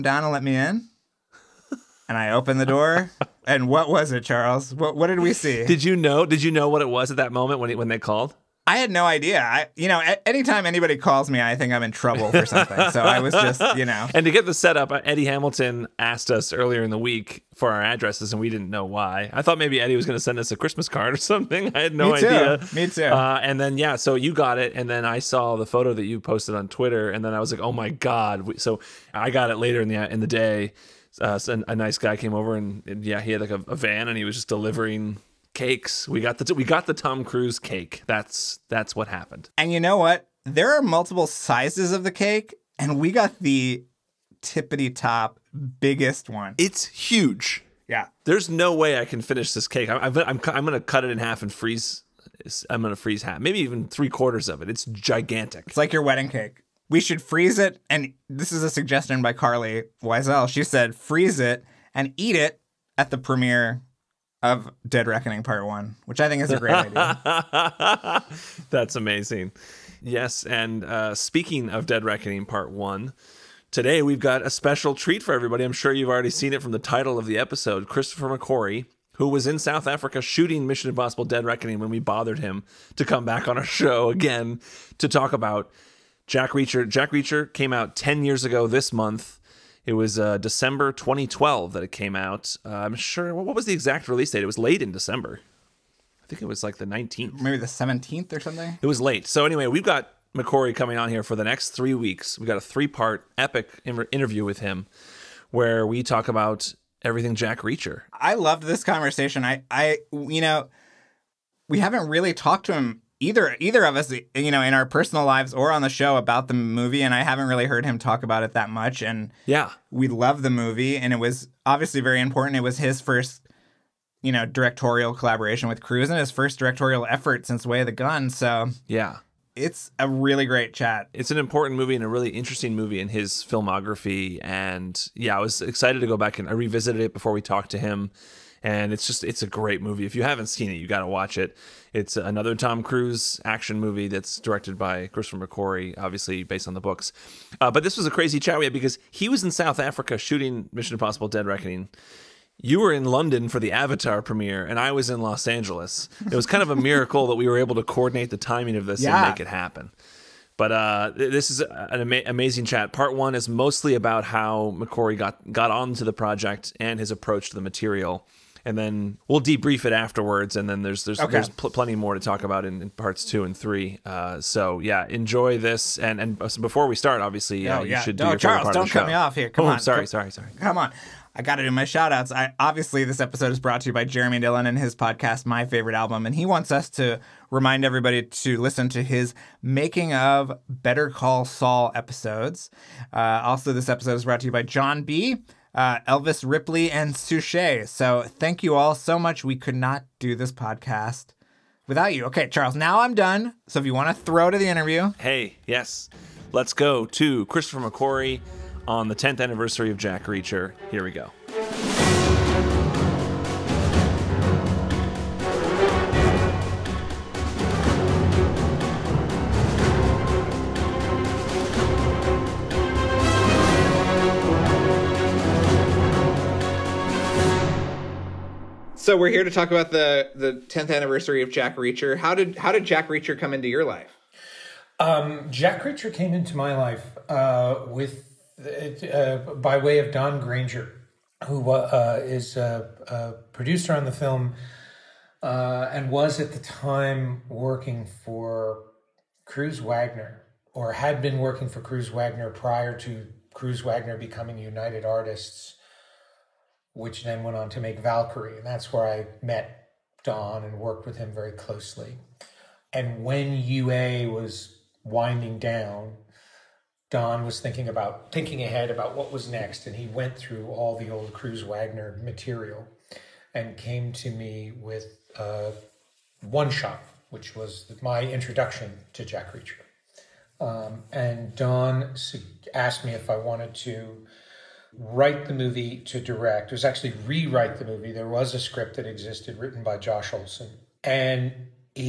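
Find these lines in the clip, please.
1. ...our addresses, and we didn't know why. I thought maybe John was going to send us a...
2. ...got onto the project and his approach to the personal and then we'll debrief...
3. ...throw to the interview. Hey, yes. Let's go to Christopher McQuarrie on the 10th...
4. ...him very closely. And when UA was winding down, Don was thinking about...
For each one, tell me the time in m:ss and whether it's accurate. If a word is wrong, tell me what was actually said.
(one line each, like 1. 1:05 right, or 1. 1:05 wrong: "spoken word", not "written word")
1. 0:17 wrong: "Eddie", not "John"
2. 2:45 wrong: "material", not "personal"
3. 3:24 right
4. 4:21 right.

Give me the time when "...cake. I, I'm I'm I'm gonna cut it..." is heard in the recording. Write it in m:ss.
0:49.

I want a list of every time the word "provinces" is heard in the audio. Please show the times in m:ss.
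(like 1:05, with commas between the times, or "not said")
not said.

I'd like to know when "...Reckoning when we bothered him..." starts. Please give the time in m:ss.
1:21.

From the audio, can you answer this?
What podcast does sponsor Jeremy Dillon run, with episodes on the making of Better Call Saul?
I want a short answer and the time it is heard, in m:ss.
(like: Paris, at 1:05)
My Favorite Album, at 3:05.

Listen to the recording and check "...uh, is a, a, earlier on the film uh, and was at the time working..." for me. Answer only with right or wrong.
wrong.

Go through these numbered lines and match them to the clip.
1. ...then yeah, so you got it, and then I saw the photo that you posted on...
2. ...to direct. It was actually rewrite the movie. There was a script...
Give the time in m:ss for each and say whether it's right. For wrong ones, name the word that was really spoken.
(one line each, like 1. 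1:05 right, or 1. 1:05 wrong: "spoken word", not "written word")
1. 0:23 right
2. 4:45 right.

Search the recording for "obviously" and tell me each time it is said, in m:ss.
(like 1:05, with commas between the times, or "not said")
2:01, 2:25, 2:57, 3:02.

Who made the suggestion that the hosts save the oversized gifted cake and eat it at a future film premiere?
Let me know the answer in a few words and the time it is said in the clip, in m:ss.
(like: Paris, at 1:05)
Carly Wiesel, at 0:59.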